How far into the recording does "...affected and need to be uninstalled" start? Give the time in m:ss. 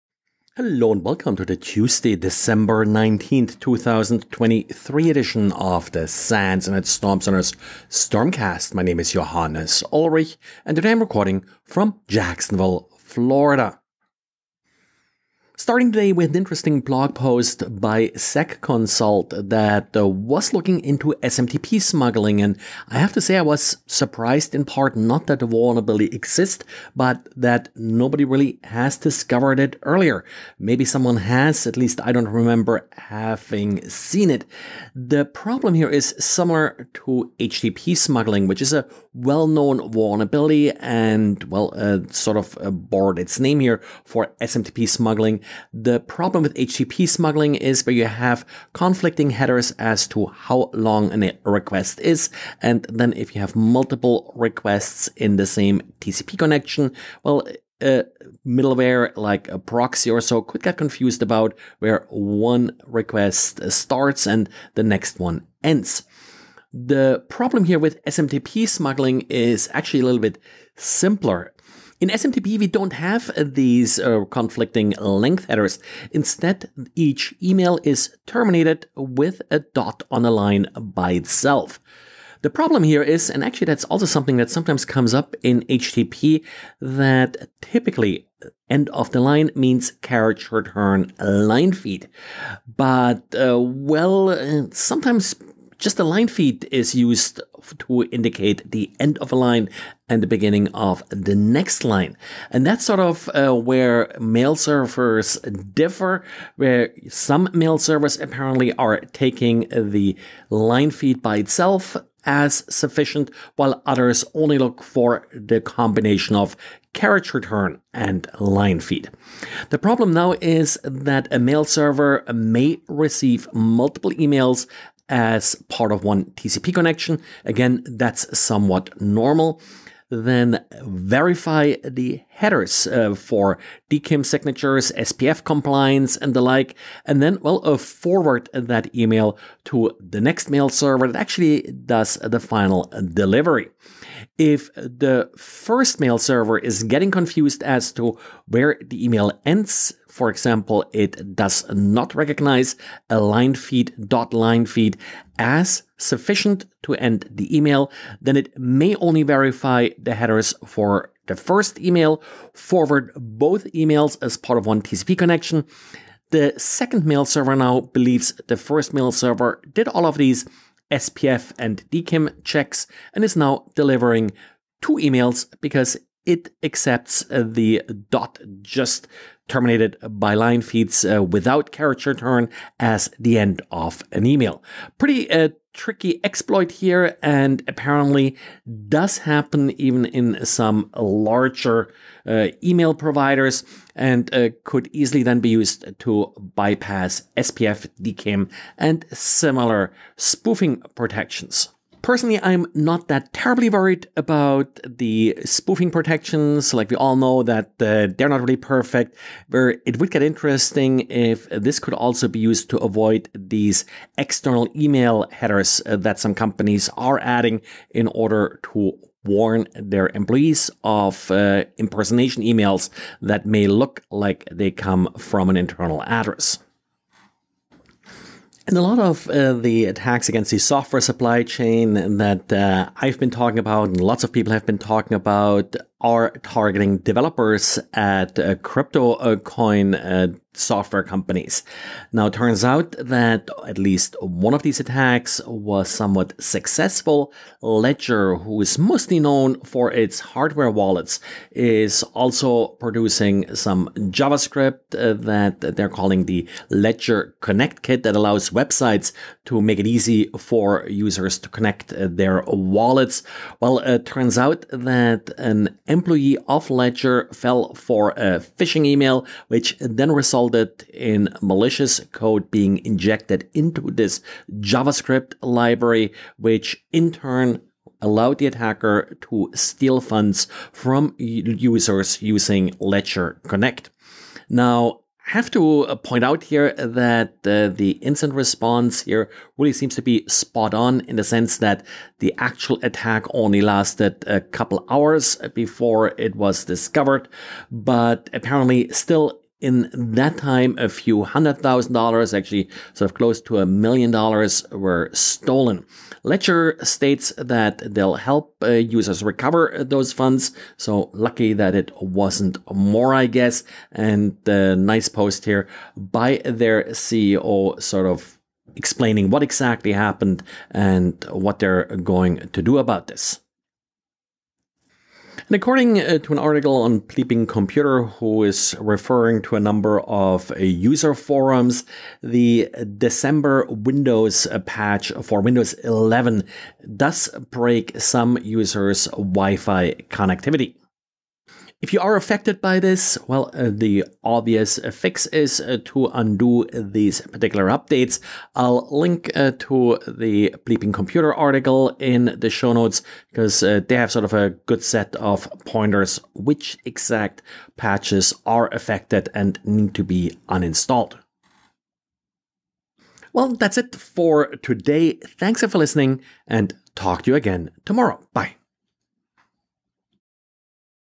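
5:58.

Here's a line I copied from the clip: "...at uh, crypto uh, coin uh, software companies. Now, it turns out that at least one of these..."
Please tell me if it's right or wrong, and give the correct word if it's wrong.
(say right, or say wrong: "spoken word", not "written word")
right.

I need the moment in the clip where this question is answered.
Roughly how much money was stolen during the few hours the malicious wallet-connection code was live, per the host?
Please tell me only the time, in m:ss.
5:03.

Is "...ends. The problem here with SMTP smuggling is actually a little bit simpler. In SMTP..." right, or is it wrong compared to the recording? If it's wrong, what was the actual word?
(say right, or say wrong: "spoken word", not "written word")
right.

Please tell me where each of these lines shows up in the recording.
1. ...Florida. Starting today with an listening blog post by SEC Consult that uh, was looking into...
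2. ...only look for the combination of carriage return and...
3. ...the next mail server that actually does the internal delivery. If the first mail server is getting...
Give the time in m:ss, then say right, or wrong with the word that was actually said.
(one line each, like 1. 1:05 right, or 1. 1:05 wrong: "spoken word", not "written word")
1. 0:12 wrong: "interesting", not "listening"
2. 1:54 right
3. 2:20 wrong: "final", not "internal".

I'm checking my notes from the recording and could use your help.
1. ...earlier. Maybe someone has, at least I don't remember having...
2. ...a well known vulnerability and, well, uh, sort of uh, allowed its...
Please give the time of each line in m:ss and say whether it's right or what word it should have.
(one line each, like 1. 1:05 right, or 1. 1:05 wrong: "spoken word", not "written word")
1. 0:29 right
2. 0:38 wrong: "borrowed", not "allowed".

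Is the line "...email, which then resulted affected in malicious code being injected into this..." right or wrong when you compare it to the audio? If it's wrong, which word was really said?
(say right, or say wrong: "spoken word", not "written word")
wrong: "resulted", not "affected".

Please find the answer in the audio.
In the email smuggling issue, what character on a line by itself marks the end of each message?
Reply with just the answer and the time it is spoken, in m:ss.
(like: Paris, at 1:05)
a dot, at 1:19.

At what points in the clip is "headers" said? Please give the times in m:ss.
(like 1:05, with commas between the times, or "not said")
0:49, 1:15, 2:12, 2:40, 3:35.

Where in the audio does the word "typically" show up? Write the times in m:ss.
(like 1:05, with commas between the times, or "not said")
1:27.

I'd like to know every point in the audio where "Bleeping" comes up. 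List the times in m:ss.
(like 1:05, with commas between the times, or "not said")
5:27, 5:50.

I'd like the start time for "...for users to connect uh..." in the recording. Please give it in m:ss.
4:20.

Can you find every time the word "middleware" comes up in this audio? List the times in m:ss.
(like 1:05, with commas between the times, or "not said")
0:58.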